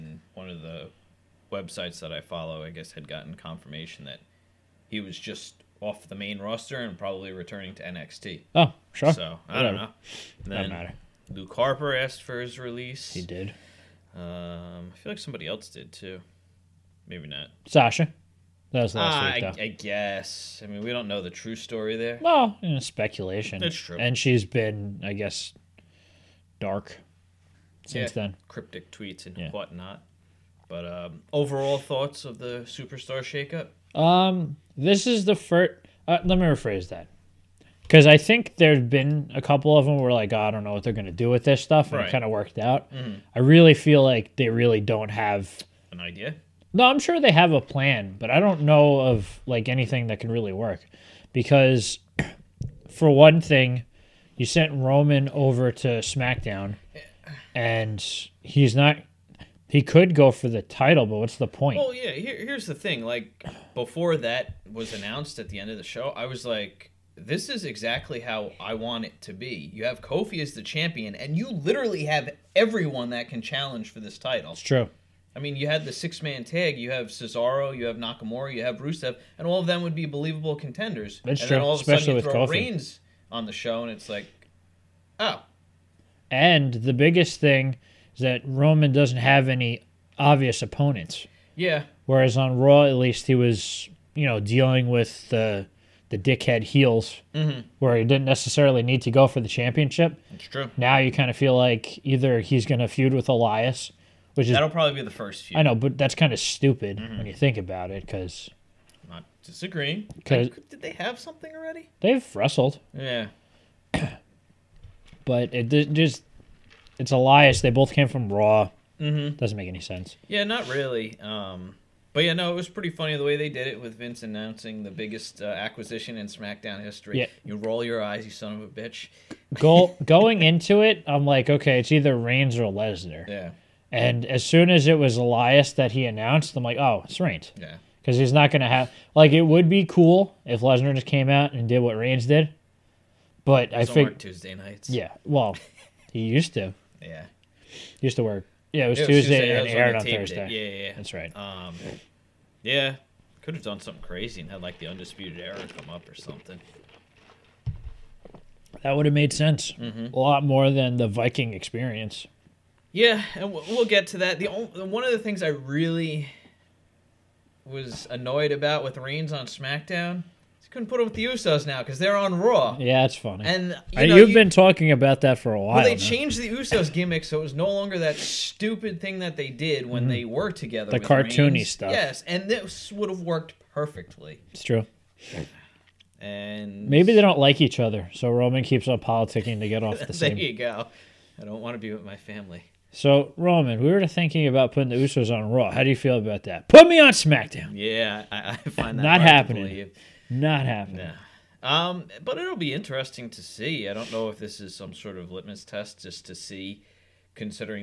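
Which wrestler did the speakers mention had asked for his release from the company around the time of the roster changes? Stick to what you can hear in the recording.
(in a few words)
Luke Harper.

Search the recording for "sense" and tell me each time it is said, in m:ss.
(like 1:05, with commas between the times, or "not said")
1:59, 2:39.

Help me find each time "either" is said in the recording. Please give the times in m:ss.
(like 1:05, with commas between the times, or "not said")
1:42, 2:11.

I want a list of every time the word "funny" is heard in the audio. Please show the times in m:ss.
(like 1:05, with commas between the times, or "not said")
2:02, 2:53.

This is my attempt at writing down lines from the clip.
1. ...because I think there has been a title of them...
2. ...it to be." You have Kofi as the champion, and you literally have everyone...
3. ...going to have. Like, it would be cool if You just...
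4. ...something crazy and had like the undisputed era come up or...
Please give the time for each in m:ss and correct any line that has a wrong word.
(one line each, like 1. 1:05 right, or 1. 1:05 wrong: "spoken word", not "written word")
1. 0:37 wrong: "couple", not "title"
2. 1:09 right
3. 2:18 wrong: "Lesnar", not "You"
4. 2:33 right.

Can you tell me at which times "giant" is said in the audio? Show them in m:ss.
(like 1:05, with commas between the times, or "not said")
not said.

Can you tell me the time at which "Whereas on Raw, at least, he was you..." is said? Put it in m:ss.
1:32.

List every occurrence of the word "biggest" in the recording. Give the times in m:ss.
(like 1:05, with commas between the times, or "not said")
1:26, 2:04.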